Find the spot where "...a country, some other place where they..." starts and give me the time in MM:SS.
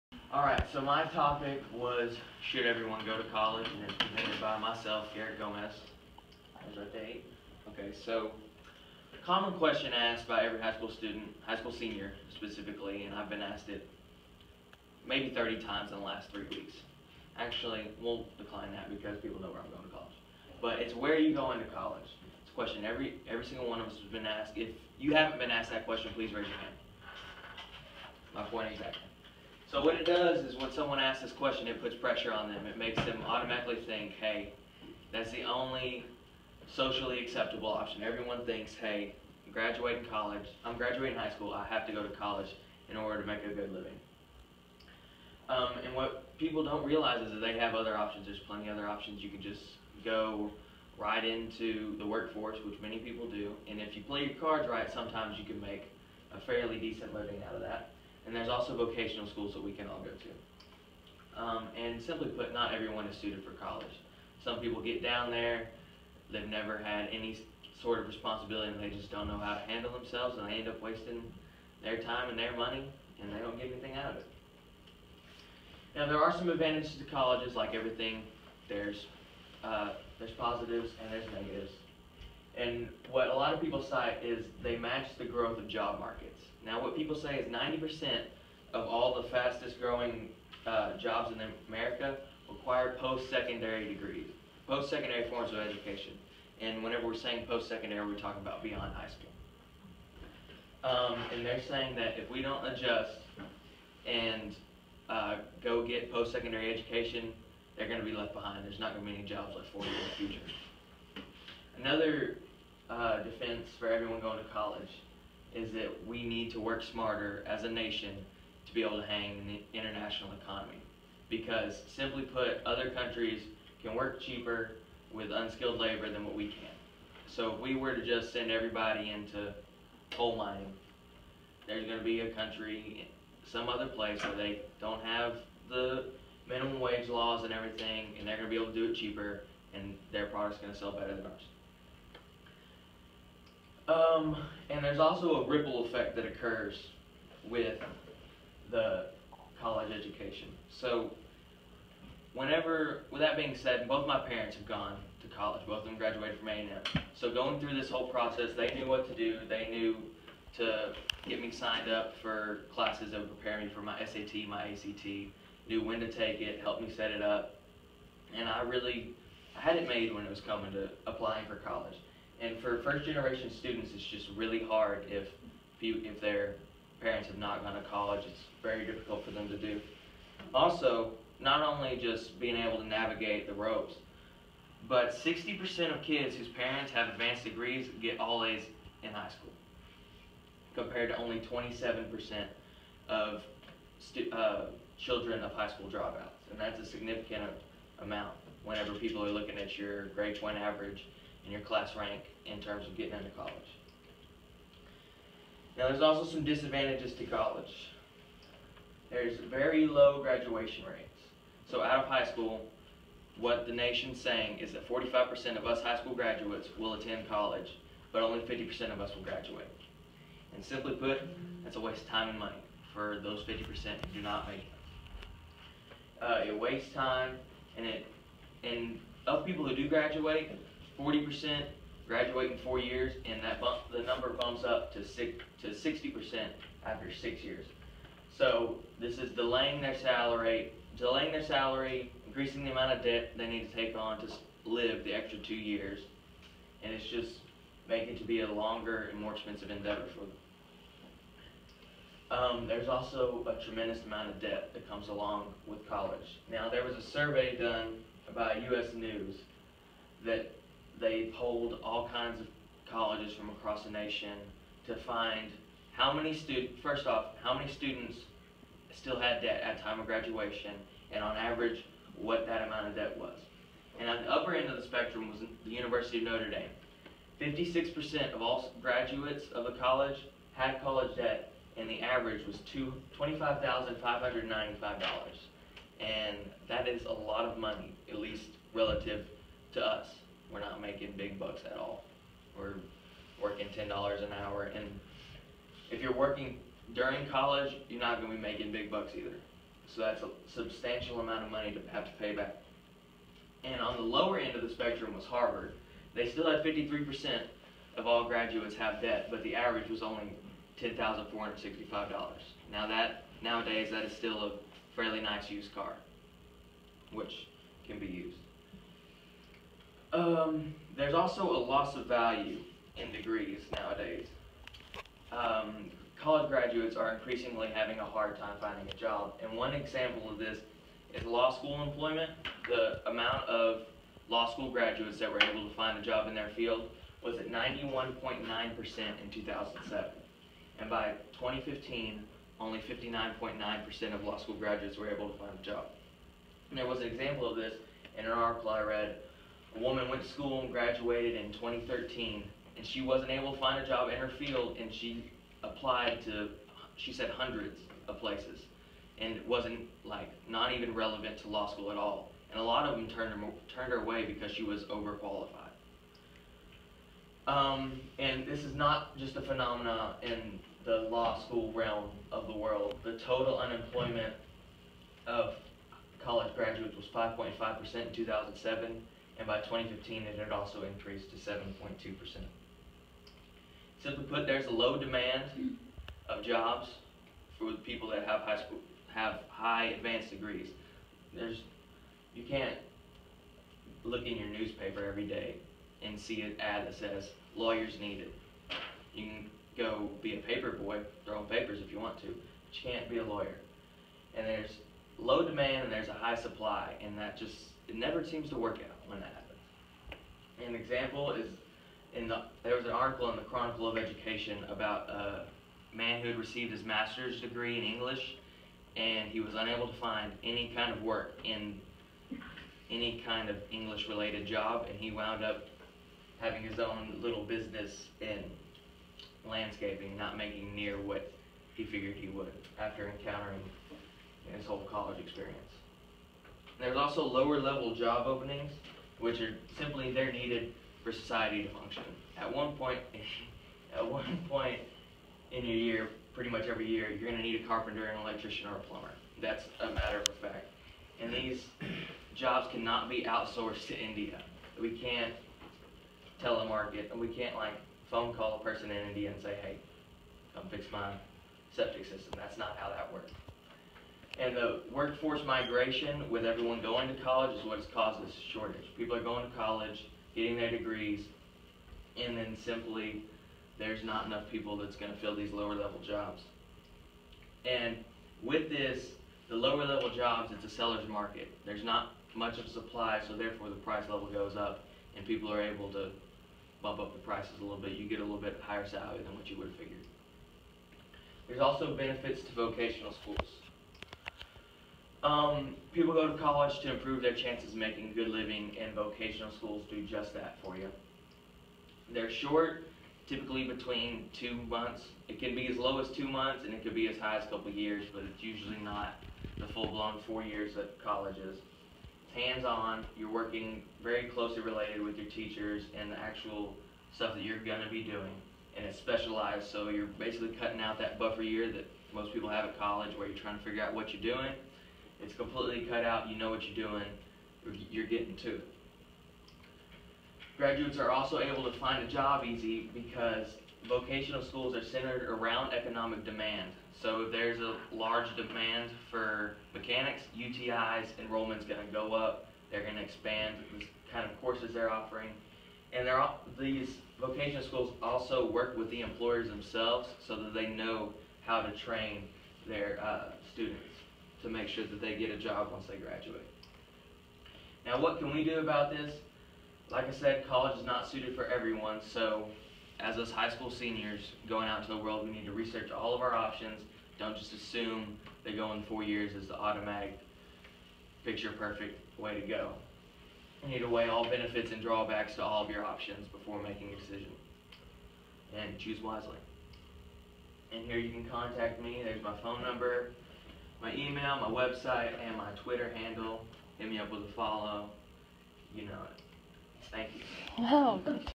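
02:12.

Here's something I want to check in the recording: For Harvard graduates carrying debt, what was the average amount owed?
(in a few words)
$10,465.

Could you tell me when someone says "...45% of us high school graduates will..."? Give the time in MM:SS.
03:34.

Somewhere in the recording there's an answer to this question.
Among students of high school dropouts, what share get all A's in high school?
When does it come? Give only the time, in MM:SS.
03:11.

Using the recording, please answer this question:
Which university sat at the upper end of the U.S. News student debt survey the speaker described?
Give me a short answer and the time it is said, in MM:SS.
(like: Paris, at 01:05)
University of Notre Dame, at 04:35.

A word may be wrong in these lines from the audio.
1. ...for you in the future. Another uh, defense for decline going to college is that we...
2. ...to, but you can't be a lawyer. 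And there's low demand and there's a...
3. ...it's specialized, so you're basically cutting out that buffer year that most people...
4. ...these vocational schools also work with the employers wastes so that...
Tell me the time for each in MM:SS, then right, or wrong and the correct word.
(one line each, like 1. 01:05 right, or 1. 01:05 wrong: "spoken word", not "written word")
1. 01:49 wrong: "everyone", not "decline"
2. 06:42 right
3. 08:38 right
4. 09:06 wrong: "themselves", not "wastes".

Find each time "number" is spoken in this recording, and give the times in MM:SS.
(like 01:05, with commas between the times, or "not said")
03:54, 09:42.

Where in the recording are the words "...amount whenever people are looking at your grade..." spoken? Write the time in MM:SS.
03:18.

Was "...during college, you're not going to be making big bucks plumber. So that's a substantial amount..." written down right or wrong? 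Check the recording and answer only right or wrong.
wrong.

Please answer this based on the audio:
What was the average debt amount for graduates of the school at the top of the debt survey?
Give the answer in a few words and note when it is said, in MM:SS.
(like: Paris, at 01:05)
$25,595, at 04:43.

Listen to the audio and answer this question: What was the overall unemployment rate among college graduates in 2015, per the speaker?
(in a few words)
7.2%.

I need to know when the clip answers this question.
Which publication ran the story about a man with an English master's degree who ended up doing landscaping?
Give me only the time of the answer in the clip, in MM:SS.
06:53.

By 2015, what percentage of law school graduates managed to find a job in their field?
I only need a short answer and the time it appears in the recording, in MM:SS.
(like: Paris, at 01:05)
59.9%, at 05:42.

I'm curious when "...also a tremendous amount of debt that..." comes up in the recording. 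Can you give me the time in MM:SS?
04:12.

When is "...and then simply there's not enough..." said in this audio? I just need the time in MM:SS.
07:52.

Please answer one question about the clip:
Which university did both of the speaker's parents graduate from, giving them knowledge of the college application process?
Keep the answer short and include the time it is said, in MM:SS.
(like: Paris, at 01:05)
A&M, at 02:36.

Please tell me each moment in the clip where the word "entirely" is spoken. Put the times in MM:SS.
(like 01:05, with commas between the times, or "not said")
not said.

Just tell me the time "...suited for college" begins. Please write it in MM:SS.
01:03.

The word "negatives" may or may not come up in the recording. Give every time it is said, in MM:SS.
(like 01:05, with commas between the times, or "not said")
01:21.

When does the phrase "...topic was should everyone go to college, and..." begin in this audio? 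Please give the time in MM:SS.
00:01.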